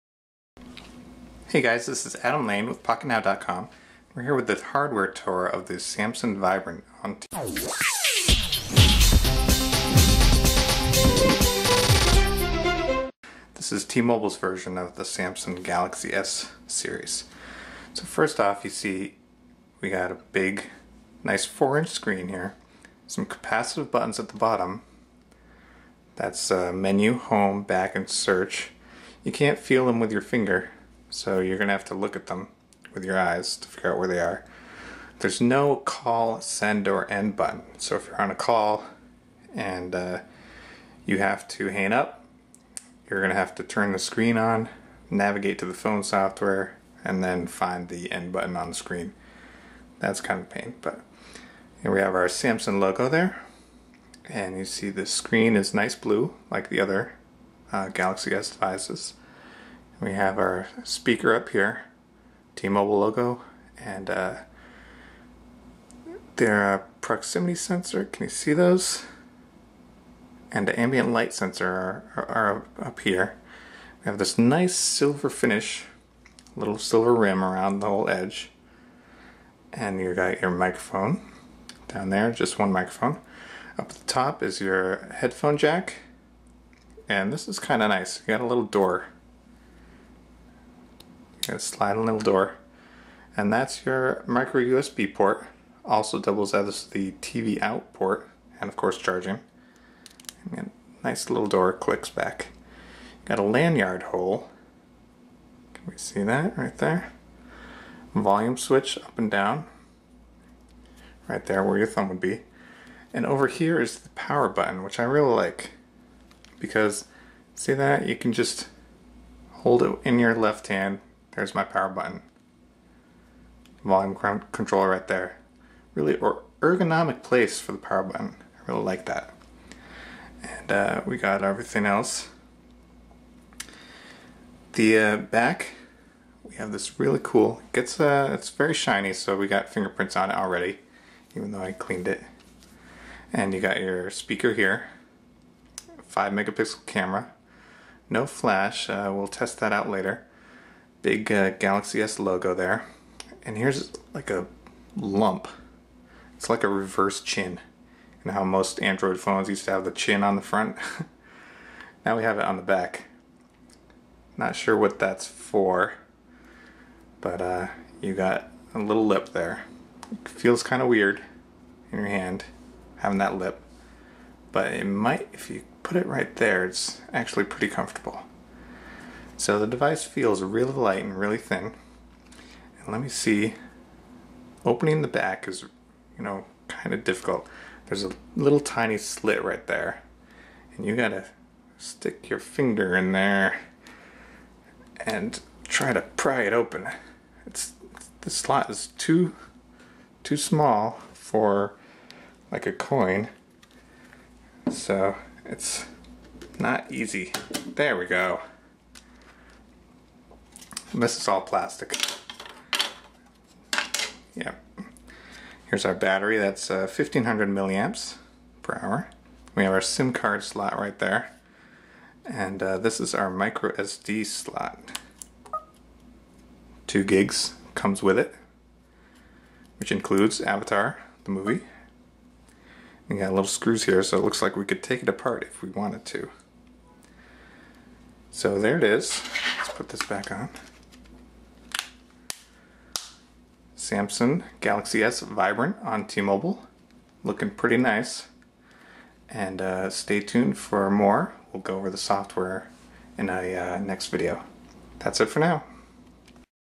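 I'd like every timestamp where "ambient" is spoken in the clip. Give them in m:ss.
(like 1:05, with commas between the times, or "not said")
1:10.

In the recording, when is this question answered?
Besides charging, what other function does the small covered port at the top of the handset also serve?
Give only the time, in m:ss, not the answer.
1:37.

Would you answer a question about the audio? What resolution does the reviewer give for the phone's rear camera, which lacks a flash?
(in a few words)
5 megapixel.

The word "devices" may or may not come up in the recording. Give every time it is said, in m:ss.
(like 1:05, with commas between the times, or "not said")
0:58, 2:59.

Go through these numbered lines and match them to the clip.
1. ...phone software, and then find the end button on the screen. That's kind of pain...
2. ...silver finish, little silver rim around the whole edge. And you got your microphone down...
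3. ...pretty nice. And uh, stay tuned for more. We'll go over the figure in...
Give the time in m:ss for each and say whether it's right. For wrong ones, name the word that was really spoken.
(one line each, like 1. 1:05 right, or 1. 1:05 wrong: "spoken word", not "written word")
1. 0:45 right
2. 1:14 right
3. 4:07 wrong: "software", not "figure".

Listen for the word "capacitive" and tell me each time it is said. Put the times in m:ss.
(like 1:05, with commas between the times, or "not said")
0:23.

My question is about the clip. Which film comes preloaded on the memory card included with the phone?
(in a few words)
Avatar.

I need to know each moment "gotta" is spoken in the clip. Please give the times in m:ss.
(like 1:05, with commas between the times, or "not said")
3:10.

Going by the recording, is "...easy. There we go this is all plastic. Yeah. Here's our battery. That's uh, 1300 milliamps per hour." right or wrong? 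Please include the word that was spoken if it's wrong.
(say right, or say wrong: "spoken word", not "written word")
wrong: "1500", not "1300".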